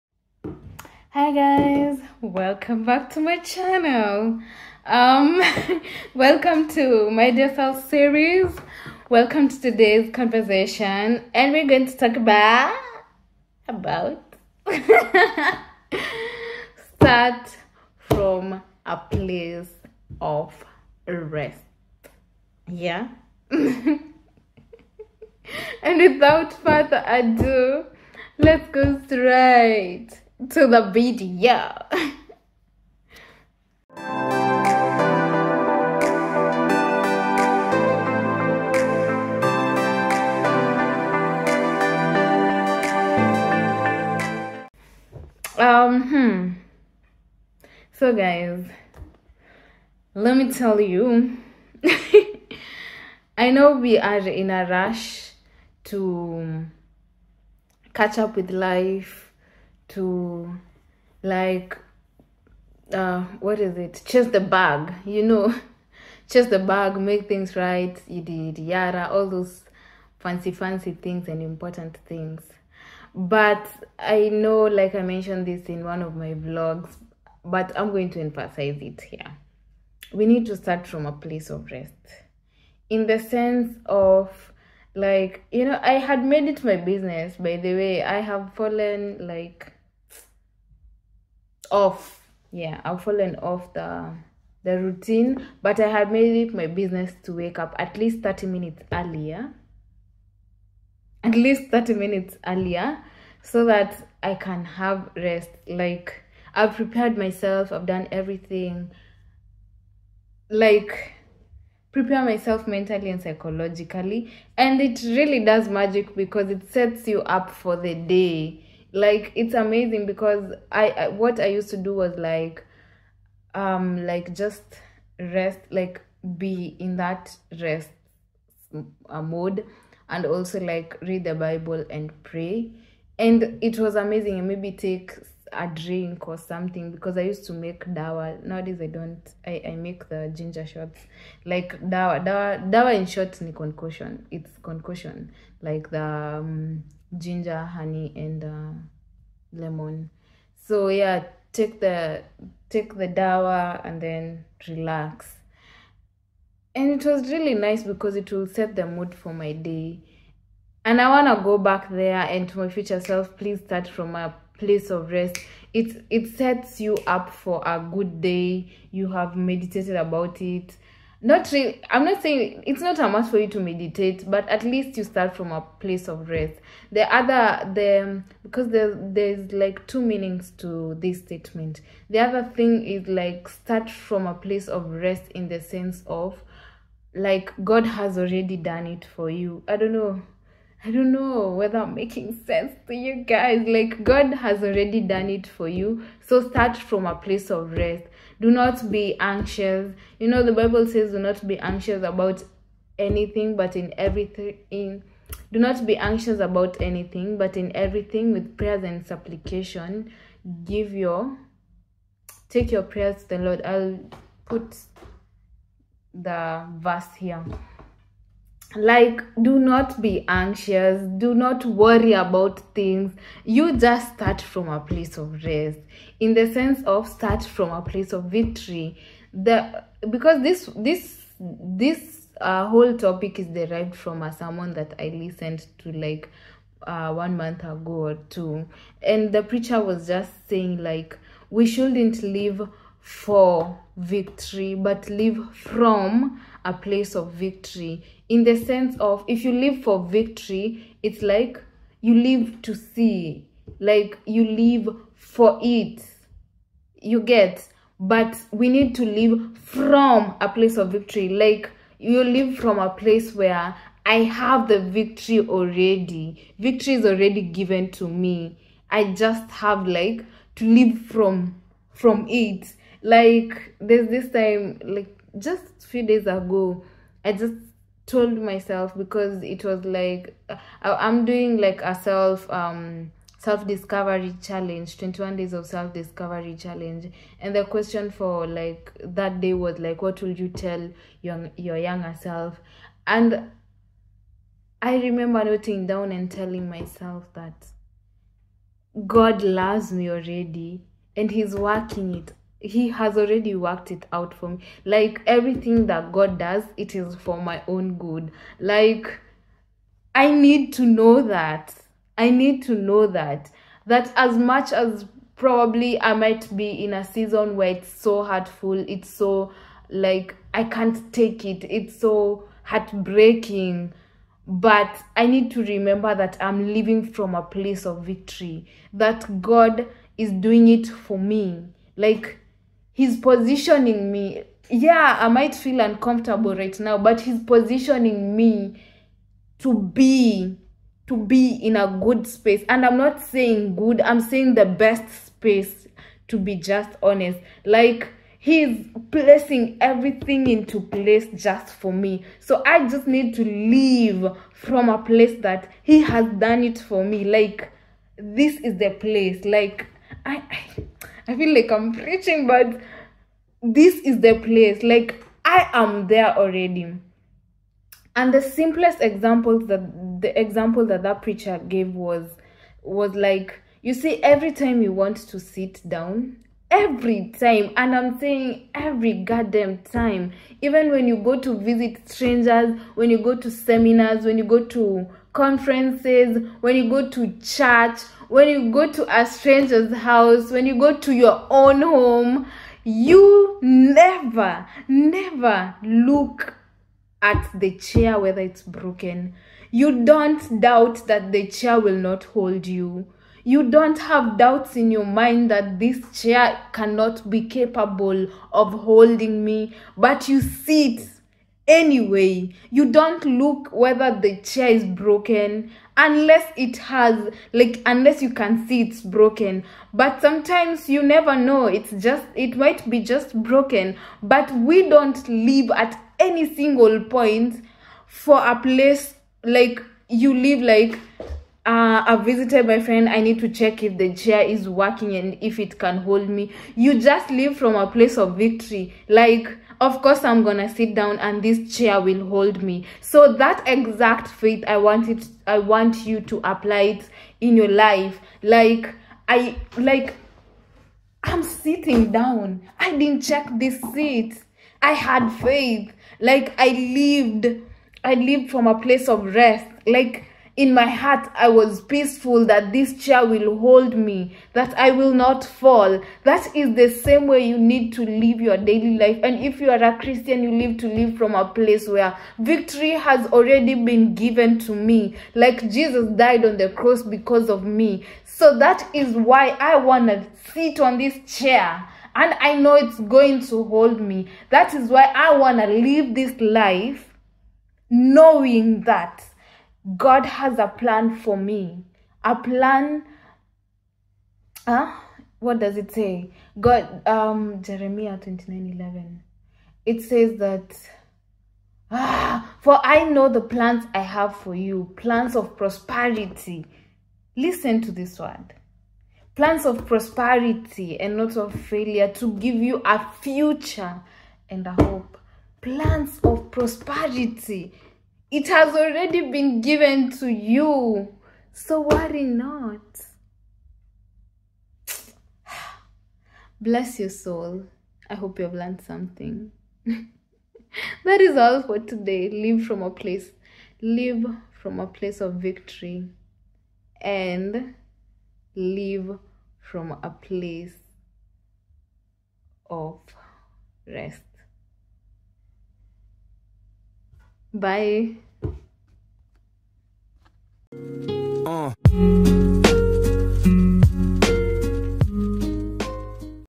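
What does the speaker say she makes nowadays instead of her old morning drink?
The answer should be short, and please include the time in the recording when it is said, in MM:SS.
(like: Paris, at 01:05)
ginger shots, at 02:19.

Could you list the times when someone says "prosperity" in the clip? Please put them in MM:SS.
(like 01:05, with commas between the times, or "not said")
08:25, 08:29, 08:36.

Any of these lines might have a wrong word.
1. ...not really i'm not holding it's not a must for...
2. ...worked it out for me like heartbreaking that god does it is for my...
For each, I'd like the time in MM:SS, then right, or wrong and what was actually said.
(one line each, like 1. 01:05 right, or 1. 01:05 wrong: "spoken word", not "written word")
1. 02:51 wrong: "saying", not "holding"
2. 05:03 wrong: "everything", not "heartbreaking".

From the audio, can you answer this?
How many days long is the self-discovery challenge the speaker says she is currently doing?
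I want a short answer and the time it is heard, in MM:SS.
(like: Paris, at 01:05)
21 days, at 04:44.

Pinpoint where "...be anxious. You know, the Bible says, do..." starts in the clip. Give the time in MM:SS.
03:18.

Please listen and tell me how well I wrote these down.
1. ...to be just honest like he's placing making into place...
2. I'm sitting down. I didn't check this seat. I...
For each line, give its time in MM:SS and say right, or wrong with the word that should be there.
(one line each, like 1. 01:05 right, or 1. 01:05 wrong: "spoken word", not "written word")
1. 05:46 wrong: "everything", not "making"
2. 07:31 right.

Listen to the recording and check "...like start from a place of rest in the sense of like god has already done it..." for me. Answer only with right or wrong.
right.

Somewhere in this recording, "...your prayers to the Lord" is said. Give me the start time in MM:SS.
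03:32.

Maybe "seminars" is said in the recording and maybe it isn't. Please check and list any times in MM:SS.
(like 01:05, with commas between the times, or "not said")
06:23.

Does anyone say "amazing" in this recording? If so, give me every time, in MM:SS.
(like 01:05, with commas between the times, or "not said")
01:59, 02:13.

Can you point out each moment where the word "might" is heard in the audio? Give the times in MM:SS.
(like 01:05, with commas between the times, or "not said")
05:16, 05:35, 07:02.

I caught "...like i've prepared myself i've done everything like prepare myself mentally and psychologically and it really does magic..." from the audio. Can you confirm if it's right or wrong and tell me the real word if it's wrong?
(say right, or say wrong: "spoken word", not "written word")
right.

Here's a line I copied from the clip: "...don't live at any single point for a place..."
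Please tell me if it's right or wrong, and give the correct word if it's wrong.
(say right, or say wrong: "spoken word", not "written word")
right.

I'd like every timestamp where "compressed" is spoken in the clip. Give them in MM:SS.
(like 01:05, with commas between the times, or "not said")
not said.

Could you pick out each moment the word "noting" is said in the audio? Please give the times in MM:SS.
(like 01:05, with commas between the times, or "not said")
04:55.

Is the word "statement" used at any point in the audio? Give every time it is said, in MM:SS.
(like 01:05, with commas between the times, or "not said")
03:01.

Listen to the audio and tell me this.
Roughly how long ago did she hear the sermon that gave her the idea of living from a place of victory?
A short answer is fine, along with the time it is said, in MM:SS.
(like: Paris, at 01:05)
one month ago, at 03:57.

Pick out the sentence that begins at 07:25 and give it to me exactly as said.
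I want you to apply it in your life.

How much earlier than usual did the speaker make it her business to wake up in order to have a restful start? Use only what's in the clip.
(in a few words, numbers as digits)
30 minutes.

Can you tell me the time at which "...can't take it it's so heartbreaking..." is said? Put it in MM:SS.
05:20.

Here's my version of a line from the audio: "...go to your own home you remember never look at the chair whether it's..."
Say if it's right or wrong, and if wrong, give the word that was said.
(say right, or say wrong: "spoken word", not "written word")
wrong: "never", not "remember".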